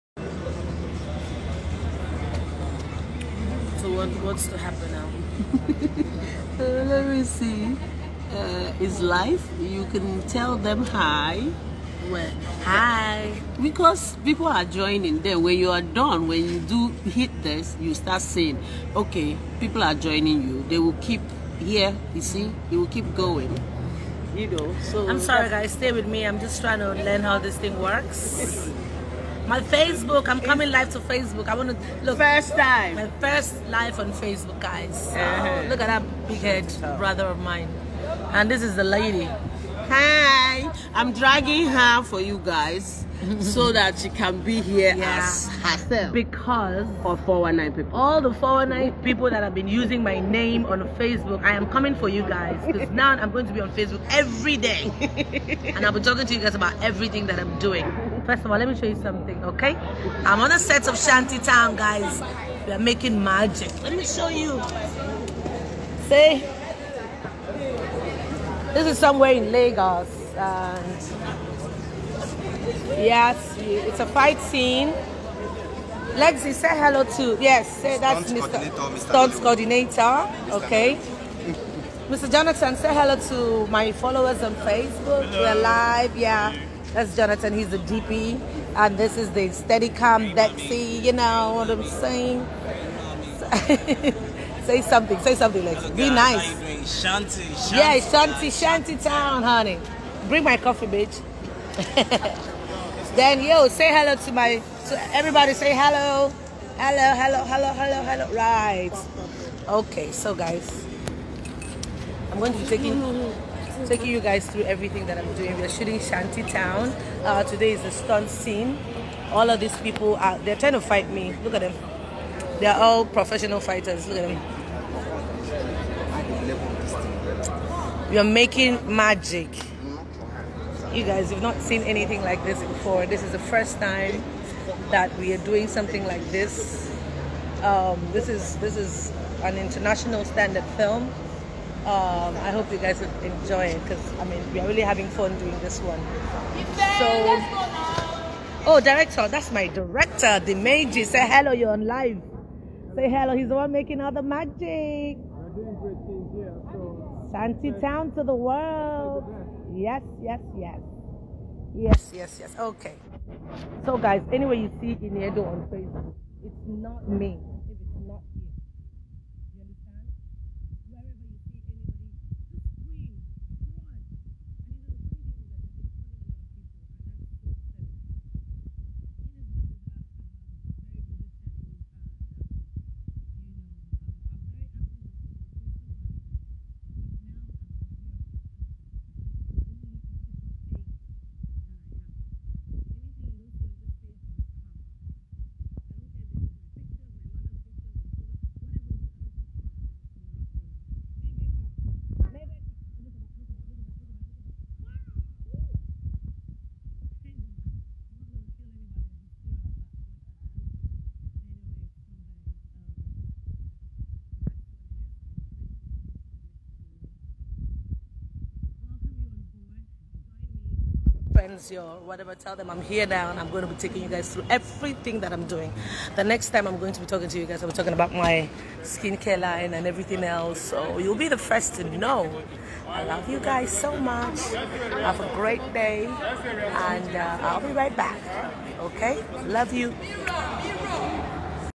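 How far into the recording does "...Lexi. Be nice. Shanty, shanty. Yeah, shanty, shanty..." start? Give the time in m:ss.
1:35.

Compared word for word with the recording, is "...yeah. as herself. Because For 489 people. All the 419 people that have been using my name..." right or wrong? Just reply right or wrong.
wrong.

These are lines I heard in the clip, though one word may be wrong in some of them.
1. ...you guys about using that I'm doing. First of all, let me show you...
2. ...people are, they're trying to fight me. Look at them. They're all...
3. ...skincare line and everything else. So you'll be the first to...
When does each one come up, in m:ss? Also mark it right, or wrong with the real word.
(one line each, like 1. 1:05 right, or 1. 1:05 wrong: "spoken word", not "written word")
1. 0:56 wrong: "everything", not "using"
2. 1:59 right
3. 3:48 right.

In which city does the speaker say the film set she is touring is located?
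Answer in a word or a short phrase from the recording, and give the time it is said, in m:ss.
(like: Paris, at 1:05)
Lagos, at 1:09.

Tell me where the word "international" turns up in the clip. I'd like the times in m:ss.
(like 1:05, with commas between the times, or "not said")
2:19.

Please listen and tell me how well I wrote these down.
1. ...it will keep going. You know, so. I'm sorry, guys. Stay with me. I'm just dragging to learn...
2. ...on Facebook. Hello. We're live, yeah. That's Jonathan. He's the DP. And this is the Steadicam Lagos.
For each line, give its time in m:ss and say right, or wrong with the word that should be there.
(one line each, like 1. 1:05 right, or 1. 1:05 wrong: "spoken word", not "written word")
1. 0:22 wrong: "trying", not "dragging"
2. 1:24 wrong: "Dexy", not "Lagos".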